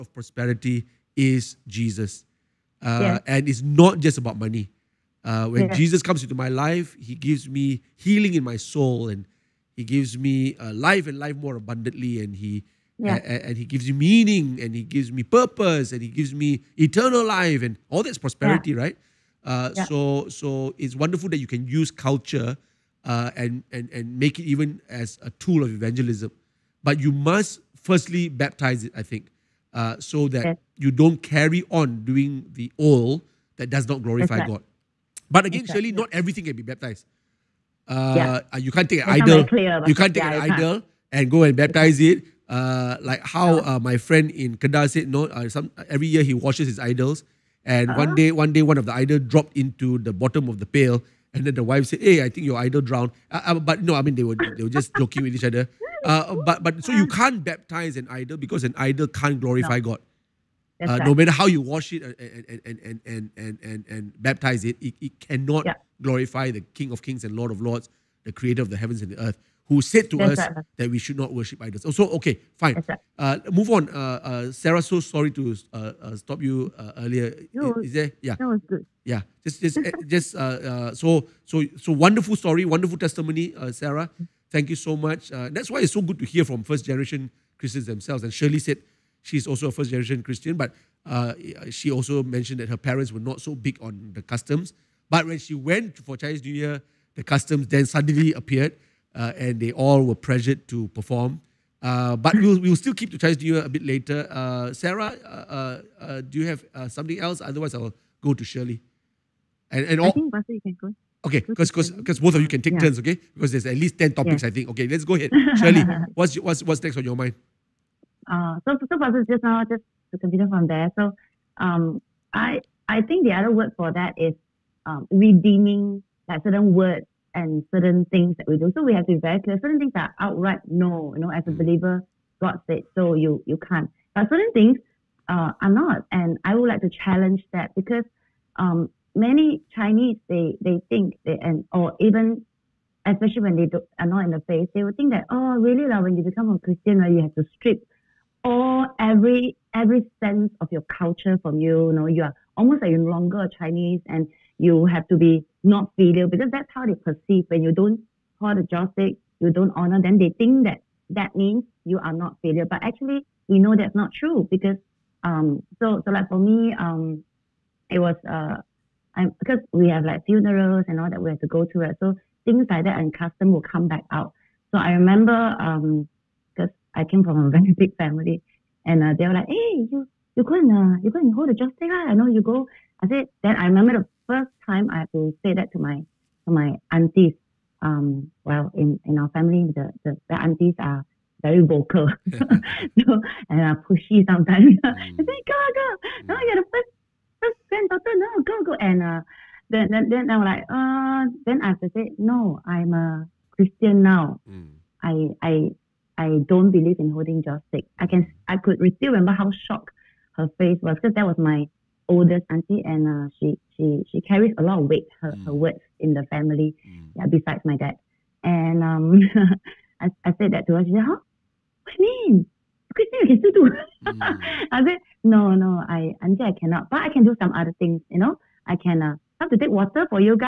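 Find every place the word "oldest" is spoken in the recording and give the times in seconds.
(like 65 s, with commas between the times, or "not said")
212 s.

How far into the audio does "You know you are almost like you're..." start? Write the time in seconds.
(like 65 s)
151 s.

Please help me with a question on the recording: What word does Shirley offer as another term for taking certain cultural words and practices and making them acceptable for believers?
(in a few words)
Redeeming.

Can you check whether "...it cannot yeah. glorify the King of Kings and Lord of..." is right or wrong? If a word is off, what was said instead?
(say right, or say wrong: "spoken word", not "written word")
right.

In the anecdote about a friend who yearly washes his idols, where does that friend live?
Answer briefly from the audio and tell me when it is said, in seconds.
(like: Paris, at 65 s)
Kedah, at 44 s.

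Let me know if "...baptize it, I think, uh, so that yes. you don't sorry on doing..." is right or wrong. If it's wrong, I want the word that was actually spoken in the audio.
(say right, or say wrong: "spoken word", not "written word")
wrong: "carry", not "sorry".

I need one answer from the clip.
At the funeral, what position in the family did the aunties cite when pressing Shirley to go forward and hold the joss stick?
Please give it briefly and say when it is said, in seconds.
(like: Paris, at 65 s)
First granddaughter, at 197 s.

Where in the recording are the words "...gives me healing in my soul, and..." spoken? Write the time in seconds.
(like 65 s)
7 s.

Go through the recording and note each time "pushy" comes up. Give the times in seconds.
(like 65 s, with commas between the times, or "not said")
193 s.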